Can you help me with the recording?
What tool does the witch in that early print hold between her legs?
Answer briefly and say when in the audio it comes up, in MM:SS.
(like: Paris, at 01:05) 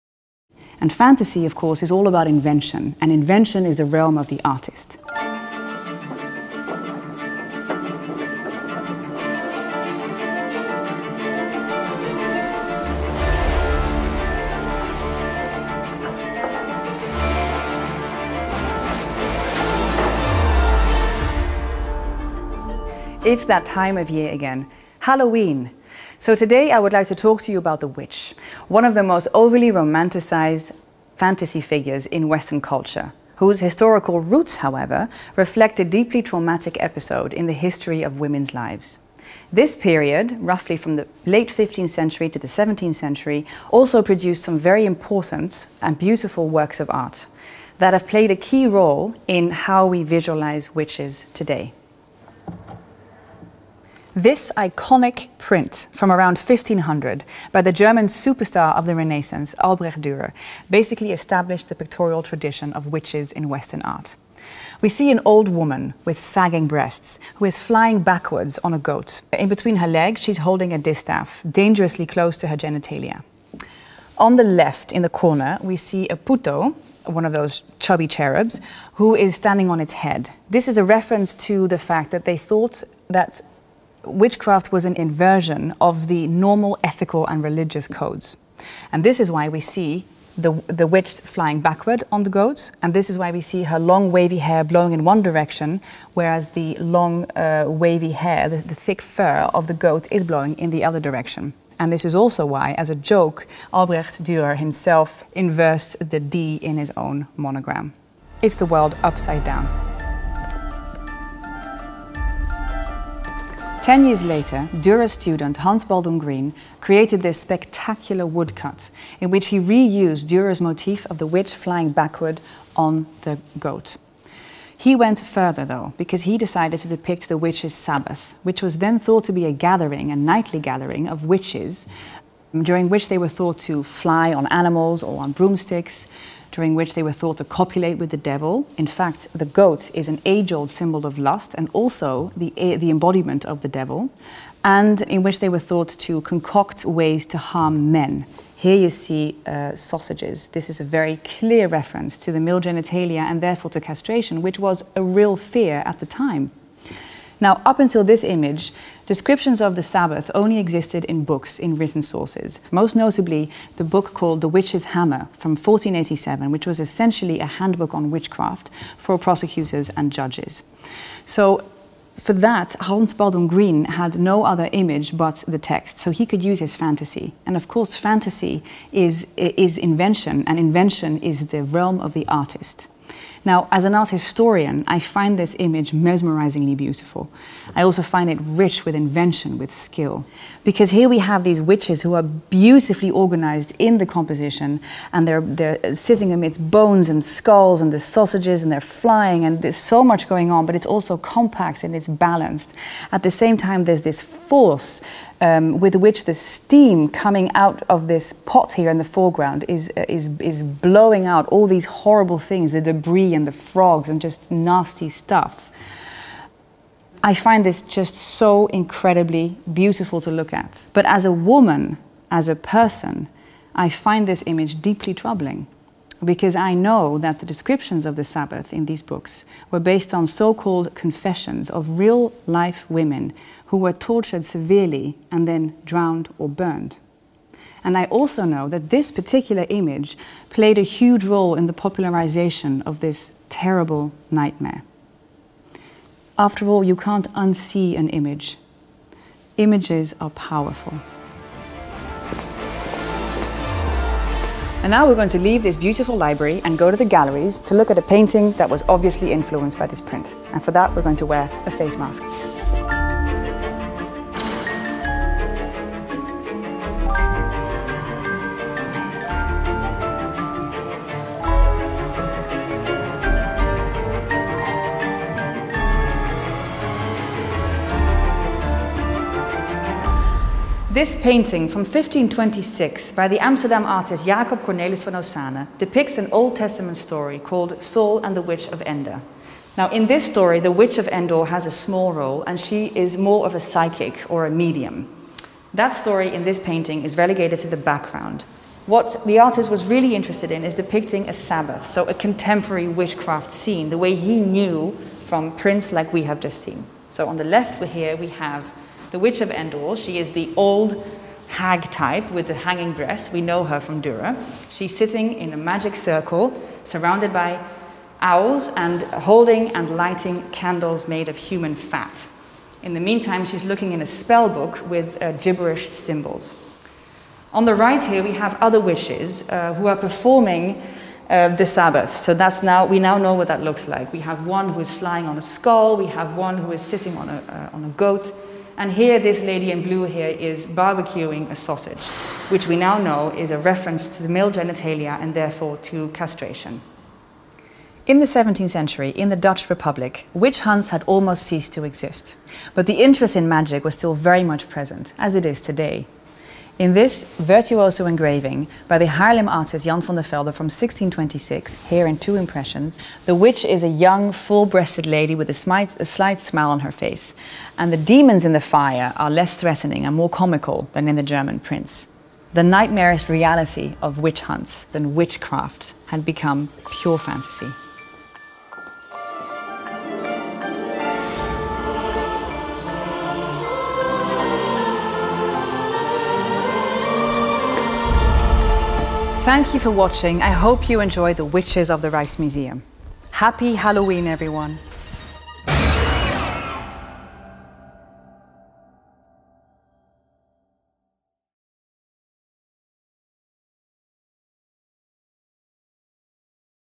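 distaff, at 01:10.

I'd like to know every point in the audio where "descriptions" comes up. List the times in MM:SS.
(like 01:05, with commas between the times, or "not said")
02:39, 03:47.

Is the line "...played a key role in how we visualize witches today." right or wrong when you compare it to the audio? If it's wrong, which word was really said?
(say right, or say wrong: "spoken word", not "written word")
right.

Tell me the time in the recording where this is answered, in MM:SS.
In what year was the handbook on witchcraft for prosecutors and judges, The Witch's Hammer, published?
02:45.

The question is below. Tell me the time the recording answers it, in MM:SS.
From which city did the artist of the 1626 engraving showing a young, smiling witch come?
05:59.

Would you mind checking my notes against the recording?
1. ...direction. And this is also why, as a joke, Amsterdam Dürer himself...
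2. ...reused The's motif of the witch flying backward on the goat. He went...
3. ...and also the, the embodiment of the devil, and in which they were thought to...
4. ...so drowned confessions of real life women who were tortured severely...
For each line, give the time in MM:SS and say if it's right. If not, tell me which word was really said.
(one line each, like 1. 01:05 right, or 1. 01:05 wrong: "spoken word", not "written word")
1. 01:41 wrong: "Albrecht", not "Amsterdam"
2. 01:59 wrong: "Dürer", not "The"
3. 02:21 right
4. 03:50 wrong: "called", not "drowned".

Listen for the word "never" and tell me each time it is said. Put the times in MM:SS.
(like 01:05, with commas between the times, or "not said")
not said.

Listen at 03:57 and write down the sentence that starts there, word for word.
And I also know that this particular image played a huge role in the popularization of this terrible nightmare.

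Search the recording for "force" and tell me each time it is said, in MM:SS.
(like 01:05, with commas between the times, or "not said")
03:24.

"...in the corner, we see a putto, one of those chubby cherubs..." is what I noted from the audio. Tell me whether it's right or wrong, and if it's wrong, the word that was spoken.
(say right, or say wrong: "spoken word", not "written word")
right.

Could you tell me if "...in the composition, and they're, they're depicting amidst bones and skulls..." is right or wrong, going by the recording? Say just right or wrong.
wrong.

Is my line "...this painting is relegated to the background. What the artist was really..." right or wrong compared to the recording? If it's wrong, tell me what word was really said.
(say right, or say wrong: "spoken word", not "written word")
right.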